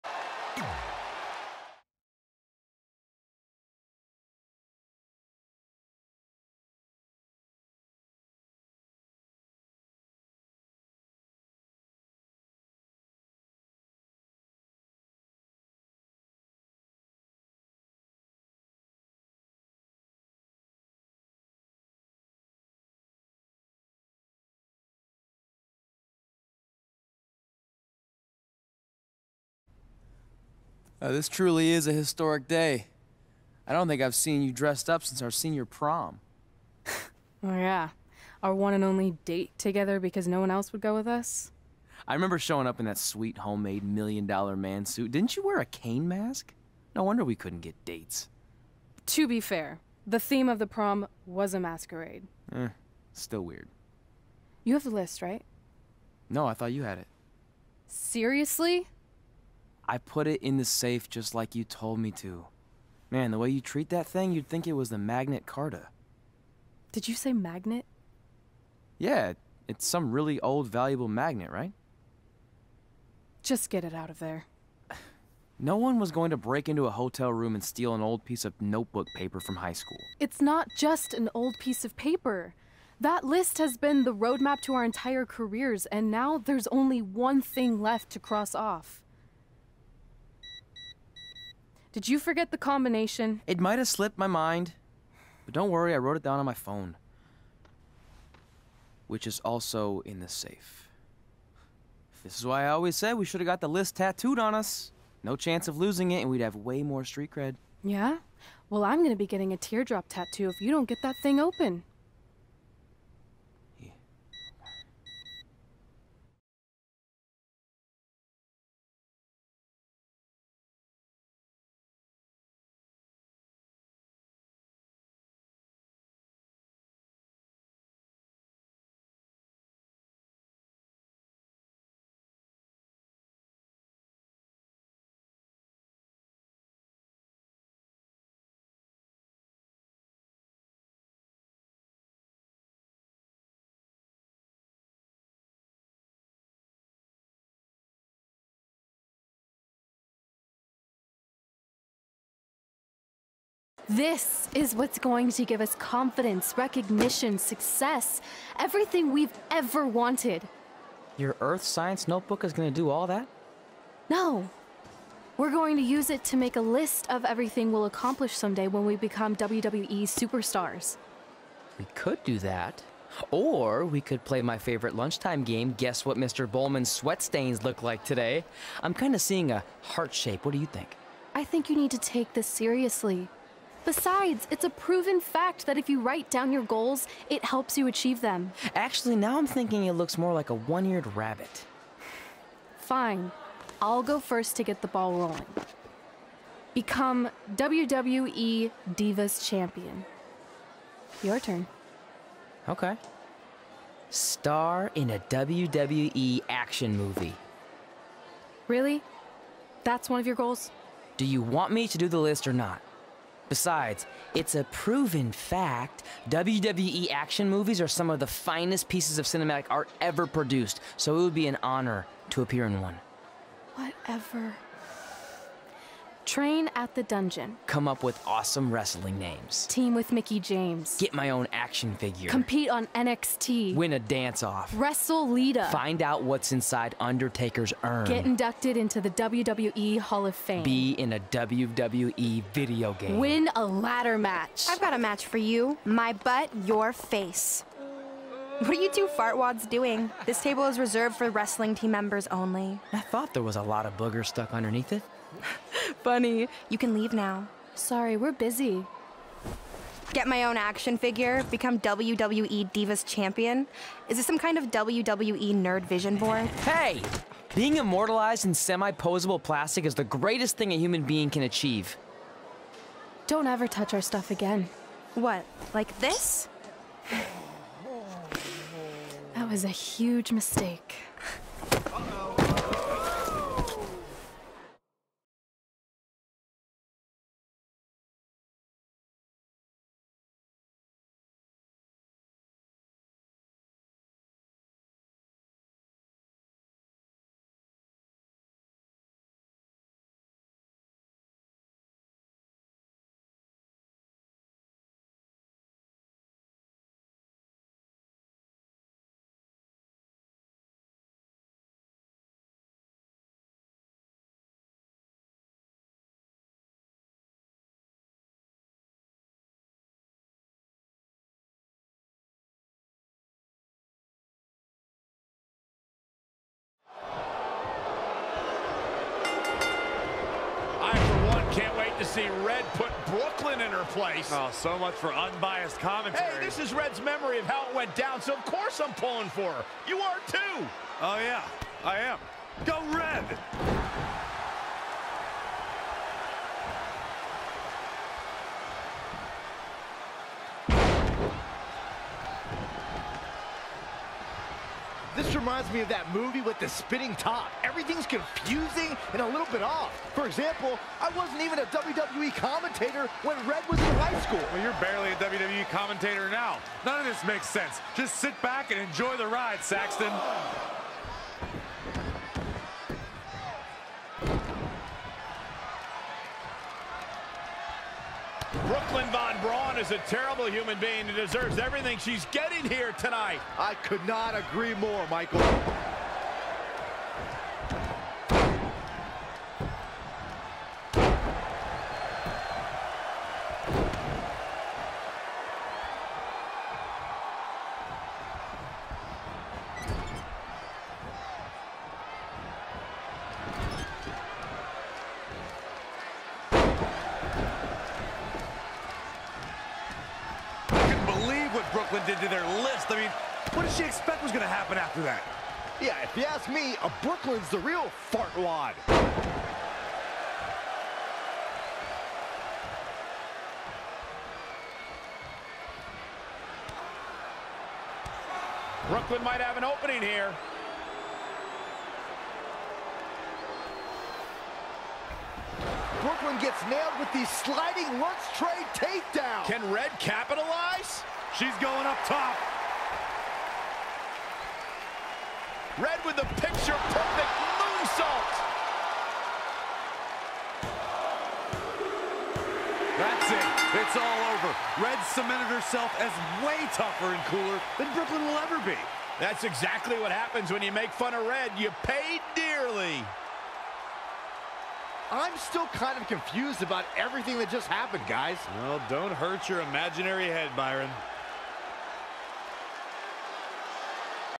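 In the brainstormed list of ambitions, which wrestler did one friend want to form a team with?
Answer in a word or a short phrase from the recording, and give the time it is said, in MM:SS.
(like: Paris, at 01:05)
Mickie James, at 03:50.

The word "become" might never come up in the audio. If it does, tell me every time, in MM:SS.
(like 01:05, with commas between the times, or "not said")
02:48, 03:16, 04:21.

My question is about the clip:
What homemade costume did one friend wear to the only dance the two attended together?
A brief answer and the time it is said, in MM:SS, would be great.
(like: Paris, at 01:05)
Million dollar man suit, at 00:43.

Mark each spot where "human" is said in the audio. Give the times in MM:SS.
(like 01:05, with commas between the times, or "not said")
04:30, 06:20.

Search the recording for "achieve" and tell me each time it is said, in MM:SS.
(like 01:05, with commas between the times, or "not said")
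03:07, 04:31.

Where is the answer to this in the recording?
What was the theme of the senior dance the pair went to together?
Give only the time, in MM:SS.
00:51.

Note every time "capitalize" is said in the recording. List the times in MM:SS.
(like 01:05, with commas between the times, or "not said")
07:19.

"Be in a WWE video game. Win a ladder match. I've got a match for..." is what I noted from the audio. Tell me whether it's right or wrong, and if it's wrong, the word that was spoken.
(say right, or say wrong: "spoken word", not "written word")
right.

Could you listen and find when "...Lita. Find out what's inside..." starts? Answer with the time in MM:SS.
03:55.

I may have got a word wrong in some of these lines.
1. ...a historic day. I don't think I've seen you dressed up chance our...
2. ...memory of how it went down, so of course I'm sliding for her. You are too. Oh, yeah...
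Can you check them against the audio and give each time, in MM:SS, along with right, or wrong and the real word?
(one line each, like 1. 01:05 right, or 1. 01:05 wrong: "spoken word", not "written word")
1. 00:31 wrong: "since", not "chance"
2. 05:36 wrong: "pulling", not "sliding".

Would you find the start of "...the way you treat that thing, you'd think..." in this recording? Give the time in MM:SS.
01:03.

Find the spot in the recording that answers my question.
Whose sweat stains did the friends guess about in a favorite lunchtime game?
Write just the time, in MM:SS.
02:56.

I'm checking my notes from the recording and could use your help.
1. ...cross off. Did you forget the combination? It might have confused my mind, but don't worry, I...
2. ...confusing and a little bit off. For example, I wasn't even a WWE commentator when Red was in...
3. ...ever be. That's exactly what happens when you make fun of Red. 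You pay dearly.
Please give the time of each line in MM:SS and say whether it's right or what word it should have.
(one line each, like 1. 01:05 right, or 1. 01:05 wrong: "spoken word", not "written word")
1. 01:28 wrong: "slipped", not "confused"
2. 05:58 right
3. 07:38 right.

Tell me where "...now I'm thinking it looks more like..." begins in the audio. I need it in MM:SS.
03:09.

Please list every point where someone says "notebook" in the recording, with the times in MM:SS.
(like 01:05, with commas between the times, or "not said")
01:18, 02:42.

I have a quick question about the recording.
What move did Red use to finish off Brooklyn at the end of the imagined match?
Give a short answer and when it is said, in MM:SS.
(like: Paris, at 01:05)
Moonsault, at 07:27.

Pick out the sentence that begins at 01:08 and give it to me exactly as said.
Yeah, it's some really old, valuable magnet, right?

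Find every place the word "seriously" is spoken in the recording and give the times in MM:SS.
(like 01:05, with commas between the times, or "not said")
00:57, 03:02.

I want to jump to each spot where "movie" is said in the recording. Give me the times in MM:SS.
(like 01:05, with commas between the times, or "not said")
03:26, 03:37, 05:56.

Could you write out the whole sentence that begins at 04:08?
What are you two fartwads doing?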